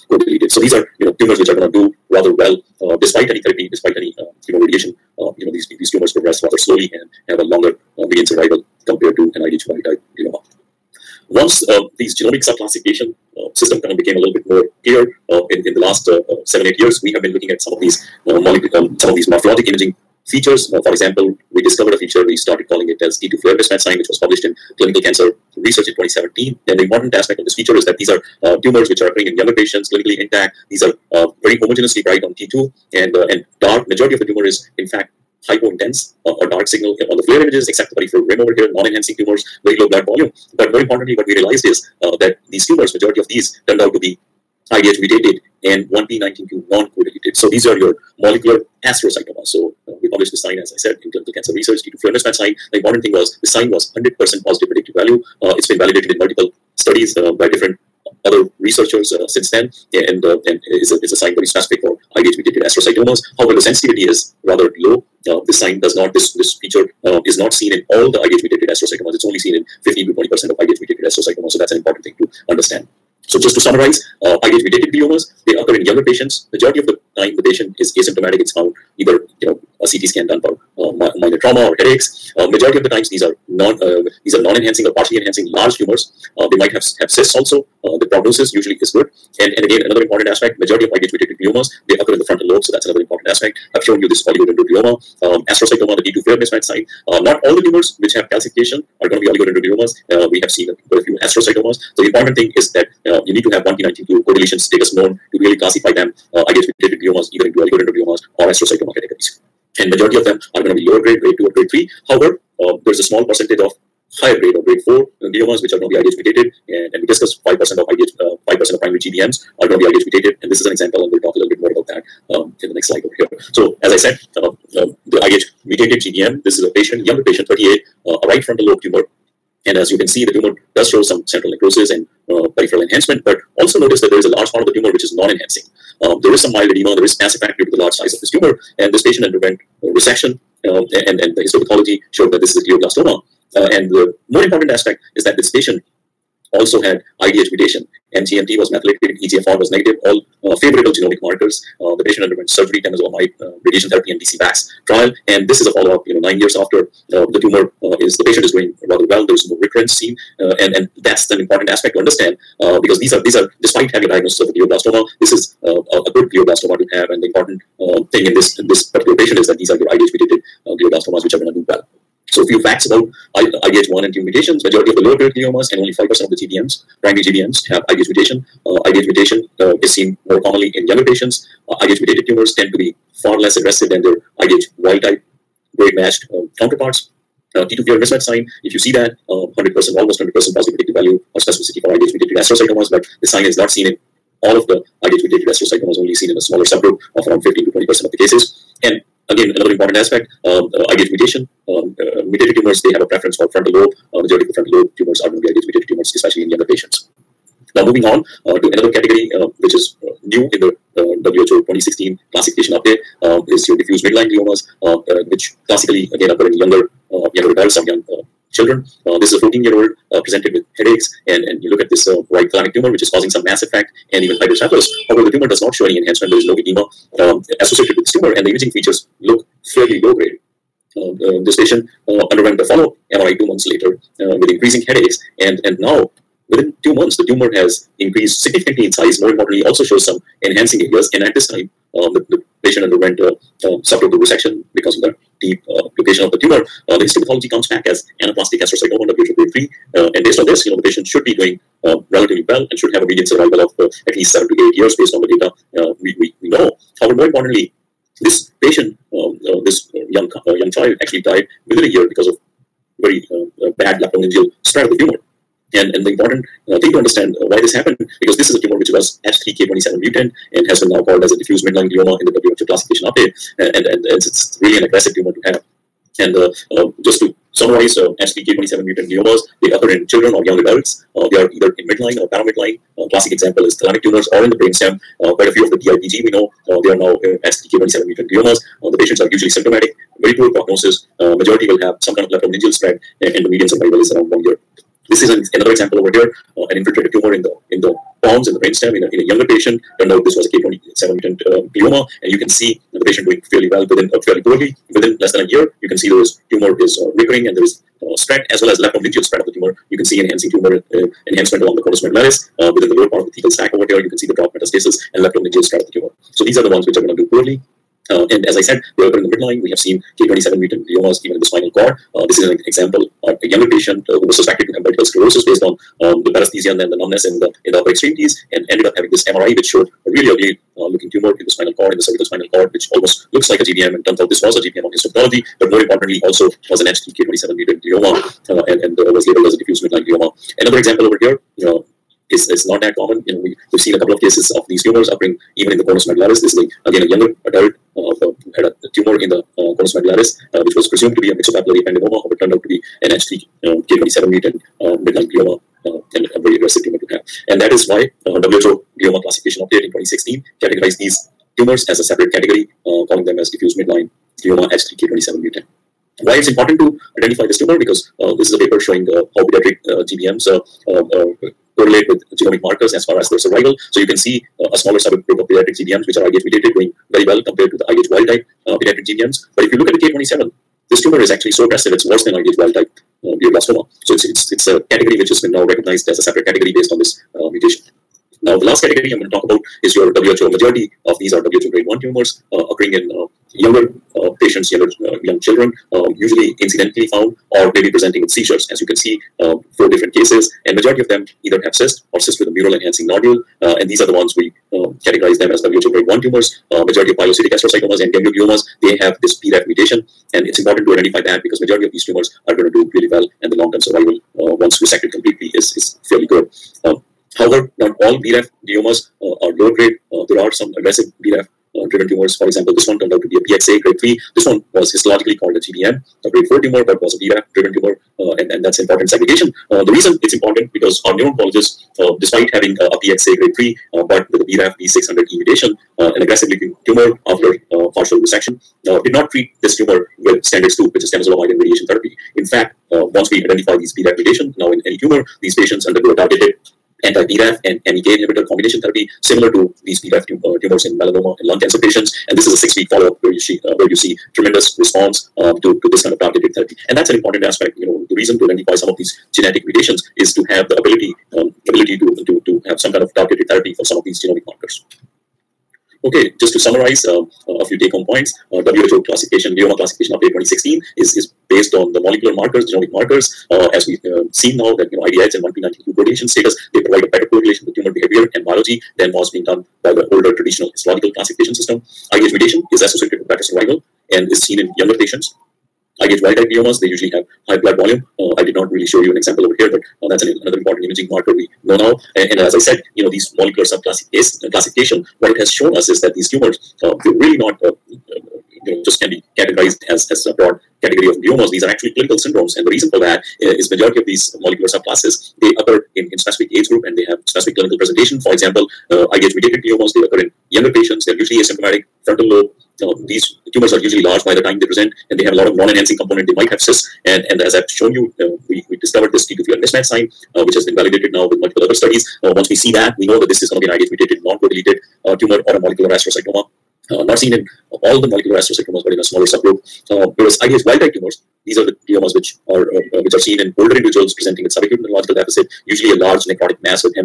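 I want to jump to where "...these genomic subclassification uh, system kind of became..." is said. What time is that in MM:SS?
00:11.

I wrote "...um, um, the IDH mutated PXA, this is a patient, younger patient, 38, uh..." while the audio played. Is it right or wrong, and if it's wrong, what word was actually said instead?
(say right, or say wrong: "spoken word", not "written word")
wrong: "GBM", not "PXA".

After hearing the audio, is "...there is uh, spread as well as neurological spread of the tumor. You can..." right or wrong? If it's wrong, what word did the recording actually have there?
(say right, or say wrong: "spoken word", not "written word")
wrong: "leptomeningeal", not "neurological".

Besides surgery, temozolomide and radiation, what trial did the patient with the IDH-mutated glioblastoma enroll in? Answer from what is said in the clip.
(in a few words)
DCVax trial.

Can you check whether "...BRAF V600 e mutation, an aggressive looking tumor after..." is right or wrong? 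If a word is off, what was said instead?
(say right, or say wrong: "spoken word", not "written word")
right.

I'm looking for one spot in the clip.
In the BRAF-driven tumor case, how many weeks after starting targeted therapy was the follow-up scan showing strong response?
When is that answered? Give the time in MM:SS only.
07:32.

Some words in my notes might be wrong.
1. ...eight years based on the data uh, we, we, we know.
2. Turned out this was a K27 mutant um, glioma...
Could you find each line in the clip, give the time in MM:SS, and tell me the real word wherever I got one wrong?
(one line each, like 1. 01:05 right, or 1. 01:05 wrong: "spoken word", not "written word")
1. 04:14 right
2. 04:59 right.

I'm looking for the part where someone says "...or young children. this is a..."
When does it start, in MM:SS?
03:37.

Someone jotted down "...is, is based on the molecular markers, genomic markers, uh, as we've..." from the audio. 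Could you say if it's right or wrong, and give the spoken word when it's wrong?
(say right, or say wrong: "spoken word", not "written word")
right.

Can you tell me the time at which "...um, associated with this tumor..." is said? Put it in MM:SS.
03:47.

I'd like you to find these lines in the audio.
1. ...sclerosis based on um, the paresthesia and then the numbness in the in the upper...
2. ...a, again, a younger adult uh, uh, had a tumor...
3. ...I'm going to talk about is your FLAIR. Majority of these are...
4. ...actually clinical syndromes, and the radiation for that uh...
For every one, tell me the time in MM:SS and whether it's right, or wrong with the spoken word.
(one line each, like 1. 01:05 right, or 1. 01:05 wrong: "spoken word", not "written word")
1. 05:25 right
2. 05:46 right
3. 06:29 wrong: "WHO", not "FLAIR"
4. 08:21 wrong: "reason", not "radiation".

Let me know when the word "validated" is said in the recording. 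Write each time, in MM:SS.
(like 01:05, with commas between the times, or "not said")
00:55, 08:40.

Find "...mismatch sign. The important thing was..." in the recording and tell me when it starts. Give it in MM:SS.
00:52.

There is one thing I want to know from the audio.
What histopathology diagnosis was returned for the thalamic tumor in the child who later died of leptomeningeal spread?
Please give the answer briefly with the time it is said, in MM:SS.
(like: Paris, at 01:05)
anaplastic astrocytoma, at 04:08.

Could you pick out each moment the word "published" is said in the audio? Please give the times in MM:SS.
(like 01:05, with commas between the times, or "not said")
00:24, 00:50.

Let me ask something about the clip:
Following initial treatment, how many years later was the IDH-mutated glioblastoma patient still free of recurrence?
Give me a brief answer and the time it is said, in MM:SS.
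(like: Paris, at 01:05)
9 years, at 02:36.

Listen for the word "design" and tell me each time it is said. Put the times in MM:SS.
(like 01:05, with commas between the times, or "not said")
not said.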